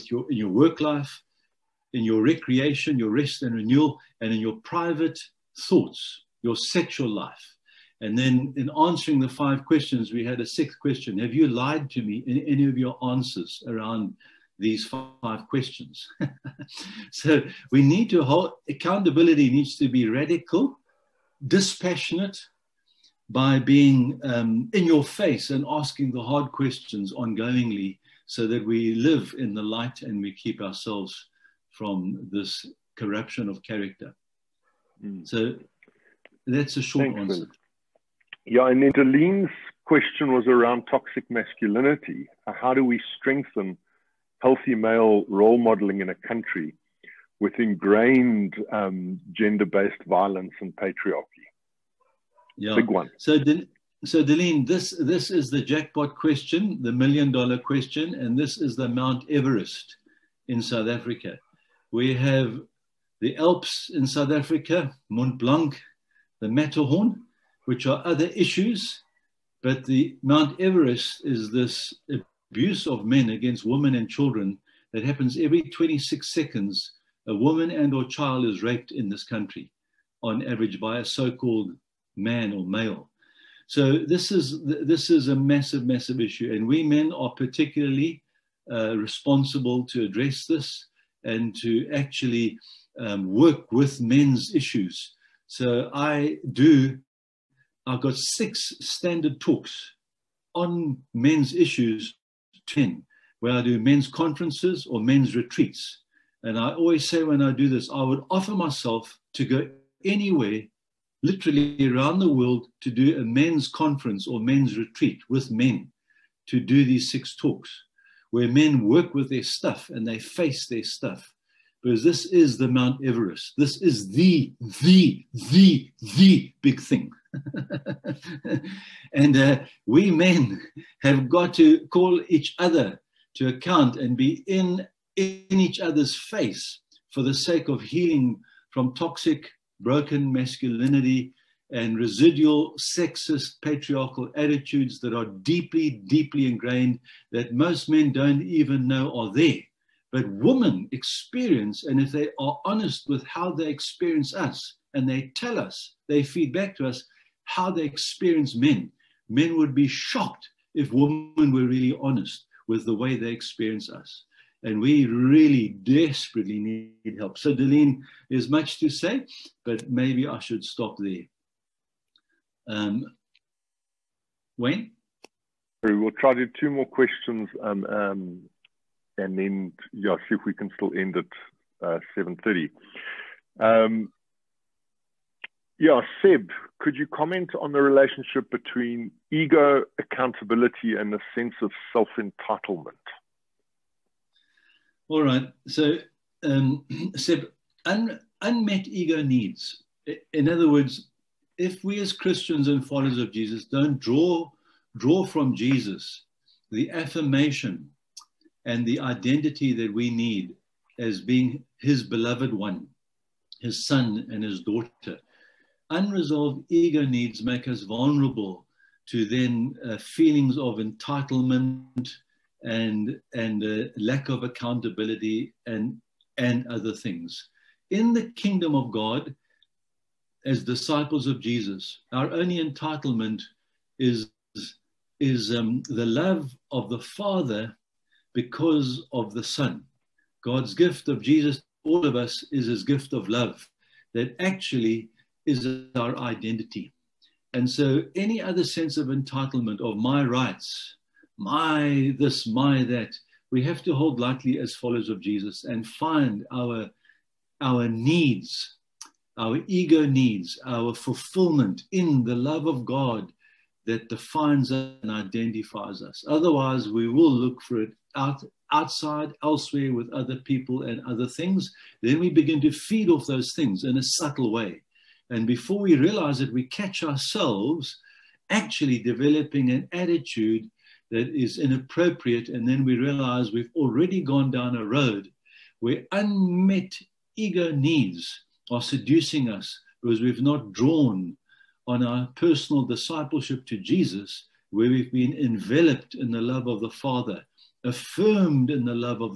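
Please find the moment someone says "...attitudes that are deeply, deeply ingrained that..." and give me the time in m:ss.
2:24.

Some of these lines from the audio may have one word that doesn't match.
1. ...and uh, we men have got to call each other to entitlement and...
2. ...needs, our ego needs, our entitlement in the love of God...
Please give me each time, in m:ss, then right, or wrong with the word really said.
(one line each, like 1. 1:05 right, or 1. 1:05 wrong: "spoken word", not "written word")
1. 2:09 wrong: "account", not "entitlement"
2. 4:17 wrong: "fulfillment", not "entitlement".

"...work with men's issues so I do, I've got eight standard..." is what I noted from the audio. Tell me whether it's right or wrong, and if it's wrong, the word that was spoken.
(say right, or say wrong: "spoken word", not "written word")
wrong: "six", not "eight".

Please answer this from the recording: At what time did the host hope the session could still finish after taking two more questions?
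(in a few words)
7:30.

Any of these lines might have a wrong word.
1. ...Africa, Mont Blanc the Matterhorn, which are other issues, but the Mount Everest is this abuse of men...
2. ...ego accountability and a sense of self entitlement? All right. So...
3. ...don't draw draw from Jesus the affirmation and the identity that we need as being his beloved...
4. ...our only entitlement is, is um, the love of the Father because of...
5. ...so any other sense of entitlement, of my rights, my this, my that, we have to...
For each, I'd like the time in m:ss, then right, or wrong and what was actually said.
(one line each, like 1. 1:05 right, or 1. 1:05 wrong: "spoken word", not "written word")
1. 1:04 right
2. 3:09 right
3. 3:23 right
4. 3:52 right
5. 4:07 right.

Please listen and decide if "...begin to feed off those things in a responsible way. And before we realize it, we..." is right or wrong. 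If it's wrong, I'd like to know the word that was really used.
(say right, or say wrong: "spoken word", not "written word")
wrong: "subtle", not "responsible".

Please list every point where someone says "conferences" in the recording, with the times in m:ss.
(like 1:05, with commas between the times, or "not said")
1:44, 1:53.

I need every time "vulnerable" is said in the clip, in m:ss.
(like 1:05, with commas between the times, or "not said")
3:37.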